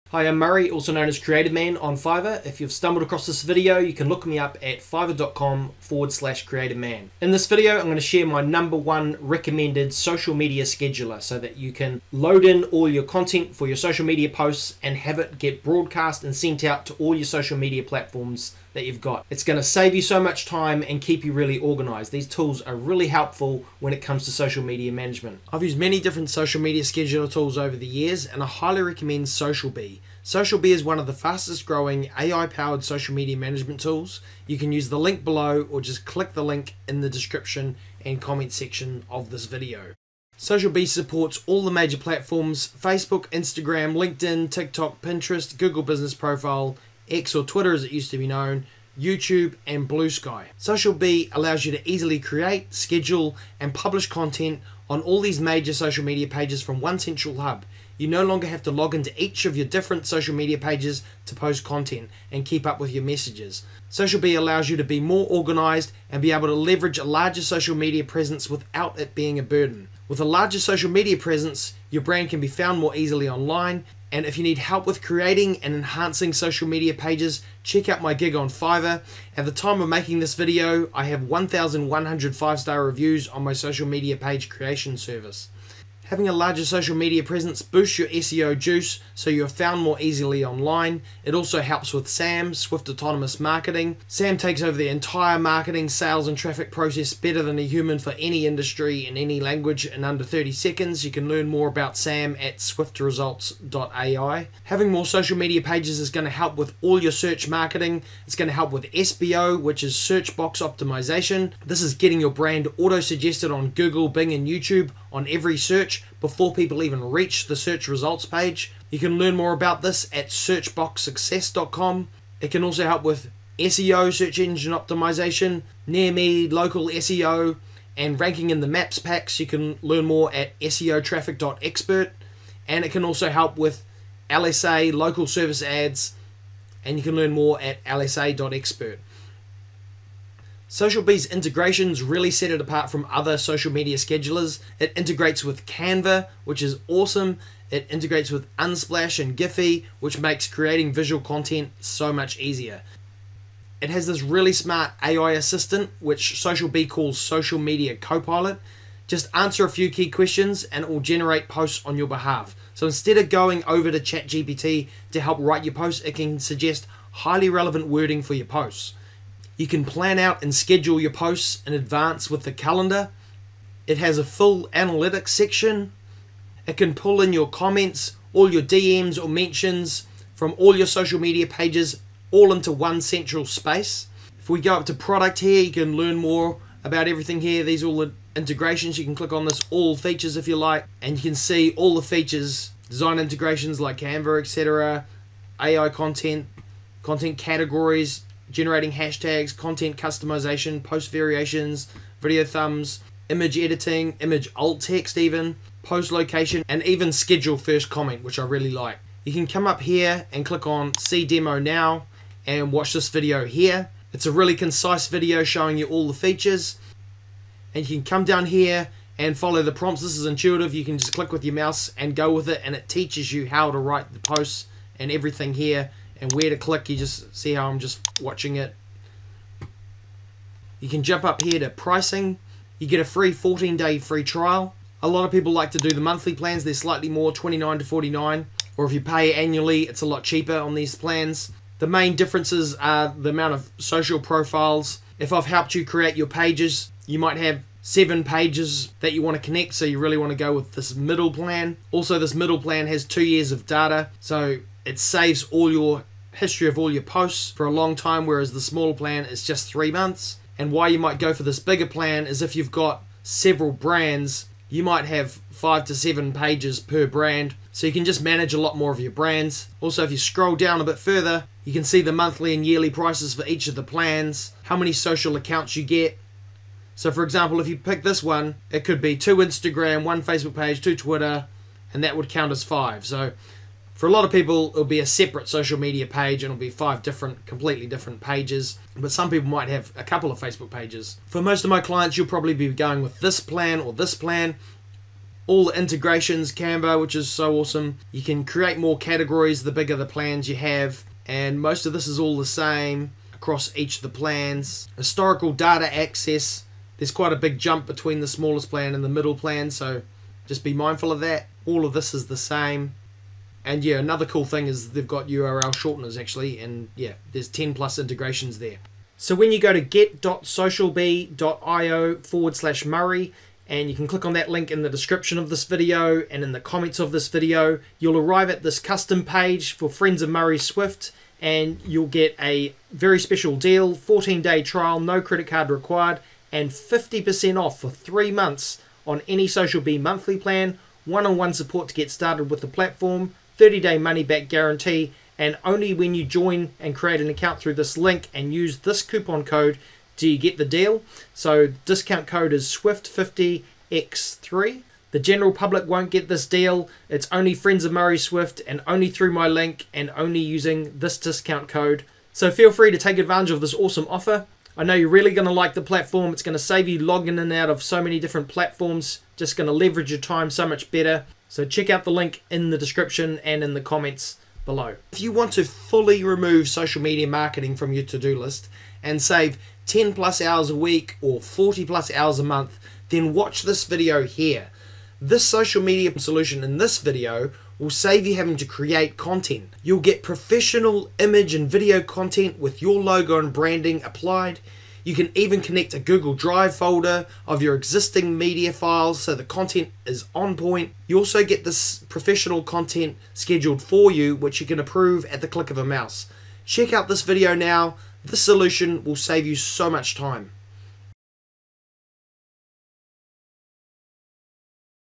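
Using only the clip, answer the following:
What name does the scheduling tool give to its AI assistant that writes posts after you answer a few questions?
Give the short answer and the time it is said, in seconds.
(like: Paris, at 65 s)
Social Media Copilot, at 157 s.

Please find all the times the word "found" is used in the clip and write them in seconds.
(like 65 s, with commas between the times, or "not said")
72 s, 89 s.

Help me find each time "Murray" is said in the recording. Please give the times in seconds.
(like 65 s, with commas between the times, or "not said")
0 s, 322 s, 330 s, 357 s.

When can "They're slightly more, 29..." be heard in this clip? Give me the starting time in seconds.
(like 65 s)
236 s.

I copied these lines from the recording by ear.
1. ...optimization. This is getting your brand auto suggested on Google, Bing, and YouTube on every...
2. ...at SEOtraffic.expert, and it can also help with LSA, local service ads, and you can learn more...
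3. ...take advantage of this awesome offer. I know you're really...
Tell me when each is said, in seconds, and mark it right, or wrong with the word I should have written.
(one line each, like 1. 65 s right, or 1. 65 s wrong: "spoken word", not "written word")
1. 110 s right
2. 130 s right
3. 362 s right.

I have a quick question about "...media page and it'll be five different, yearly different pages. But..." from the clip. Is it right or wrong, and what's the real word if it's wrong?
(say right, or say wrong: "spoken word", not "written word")
wrong: "completely", not "yearly".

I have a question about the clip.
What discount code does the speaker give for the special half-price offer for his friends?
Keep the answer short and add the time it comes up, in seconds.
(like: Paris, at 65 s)
SWIFT50X3, at 352 s.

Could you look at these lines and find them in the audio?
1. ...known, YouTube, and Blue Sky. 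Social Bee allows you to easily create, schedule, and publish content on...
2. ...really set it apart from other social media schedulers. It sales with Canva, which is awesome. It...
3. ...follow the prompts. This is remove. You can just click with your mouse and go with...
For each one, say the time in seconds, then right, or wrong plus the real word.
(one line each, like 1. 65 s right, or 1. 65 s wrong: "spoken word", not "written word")
1. 48 s right
2. 142 s wrong: "integrates", not "sales"
3. 219 s wrong: "intuitive", not "remove".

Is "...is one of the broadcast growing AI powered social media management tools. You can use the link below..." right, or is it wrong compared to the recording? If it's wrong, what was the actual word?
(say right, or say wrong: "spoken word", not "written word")
wrong: "fastest", not "broadcast".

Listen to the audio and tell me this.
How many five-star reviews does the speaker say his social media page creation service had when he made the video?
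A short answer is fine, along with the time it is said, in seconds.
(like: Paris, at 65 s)
1,100, at 81 s.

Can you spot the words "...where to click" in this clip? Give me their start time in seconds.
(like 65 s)
226 s.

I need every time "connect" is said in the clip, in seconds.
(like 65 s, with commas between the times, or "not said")
249 s, 395 s.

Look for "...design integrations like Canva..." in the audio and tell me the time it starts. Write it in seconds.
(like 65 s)
192 s.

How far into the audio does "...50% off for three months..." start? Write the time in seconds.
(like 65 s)
336 s.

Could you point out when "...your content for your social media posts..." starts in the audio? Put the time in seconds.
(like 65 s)
12 s.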